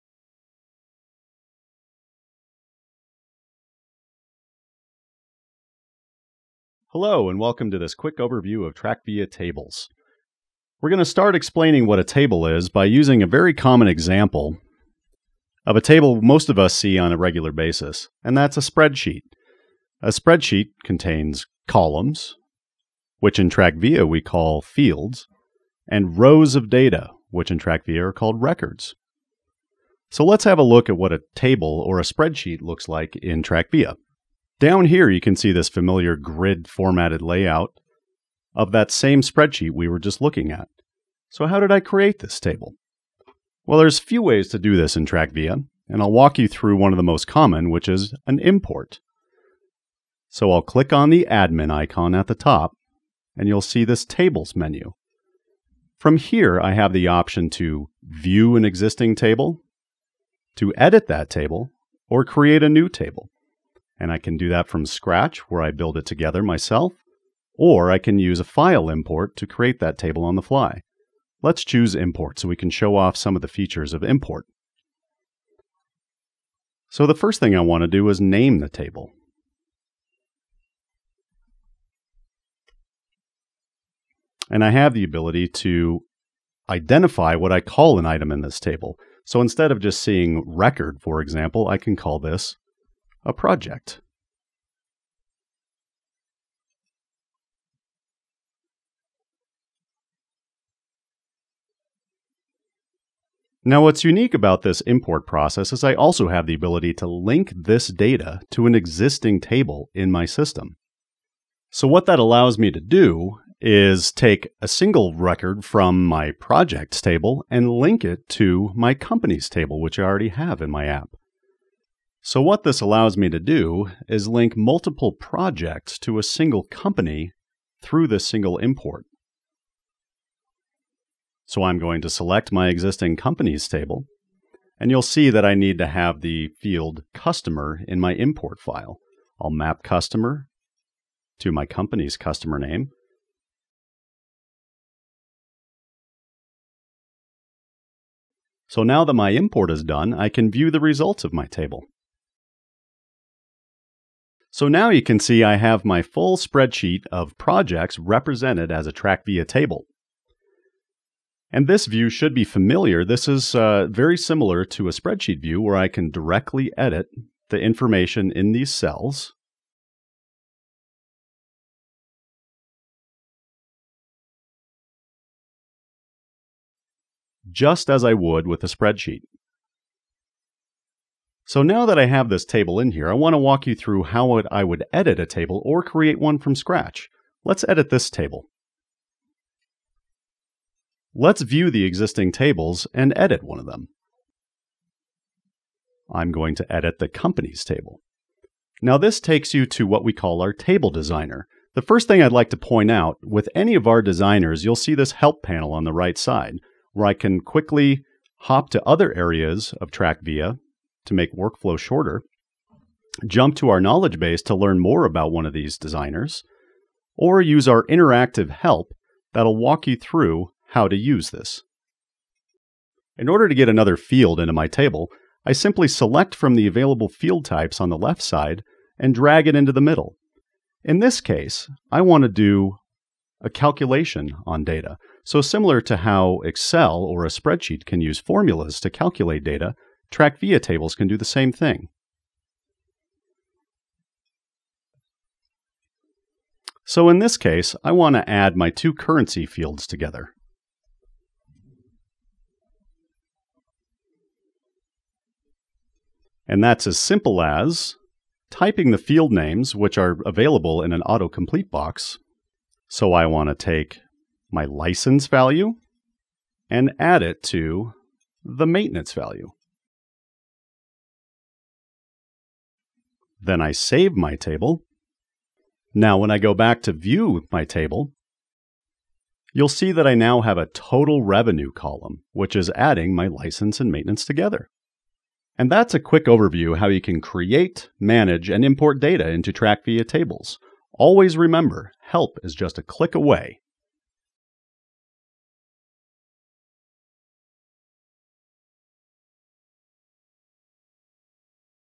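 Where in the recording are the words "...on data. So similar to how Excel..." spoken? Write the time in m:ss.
3:54.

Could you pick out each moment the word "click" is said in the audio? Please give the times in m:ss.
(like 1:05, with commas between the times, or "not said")
0:50, 4:52.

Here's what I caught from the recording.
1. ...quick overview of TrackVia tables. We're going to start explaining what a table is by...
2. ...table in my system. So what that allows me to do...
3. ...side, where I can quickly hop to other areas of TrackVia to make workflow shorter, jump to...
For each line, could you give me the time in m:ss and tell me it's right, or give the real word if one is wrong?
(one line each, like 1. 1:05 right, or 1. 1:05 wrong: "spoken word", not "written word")
1. 0:07 right
2. 1:49 right
3. 3:26 right.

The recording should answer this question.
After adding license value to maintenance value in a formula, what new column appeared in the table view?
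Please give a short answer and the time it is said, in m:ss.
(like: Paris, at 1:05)
total revenue, at 4:40.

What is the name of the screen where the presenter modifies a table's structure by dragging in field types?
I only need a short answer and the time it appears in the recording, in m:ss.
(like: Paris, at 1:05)
table designer, at 3:20.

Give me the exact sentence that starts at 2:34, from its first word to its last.
So now you can see I have my full spreadsheet of projects represented as a TrackVia table.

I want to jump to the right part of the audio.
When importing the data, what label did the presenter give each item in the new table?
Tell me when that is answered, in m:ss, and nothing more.
1:33.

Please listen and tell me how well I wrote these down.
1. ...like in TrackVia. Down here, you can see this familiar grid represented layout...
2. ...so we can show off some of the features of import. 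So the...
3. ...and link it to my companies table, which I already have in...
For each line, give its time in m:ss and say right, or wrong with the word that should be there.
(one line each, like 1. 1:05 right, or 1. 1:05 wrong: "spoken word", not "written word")
1. 0:32 wrong: "formatted", not "represented"
2. 1:12 right
3. 1:57 right.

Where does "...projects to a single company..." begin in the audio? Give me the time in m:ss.
2:05.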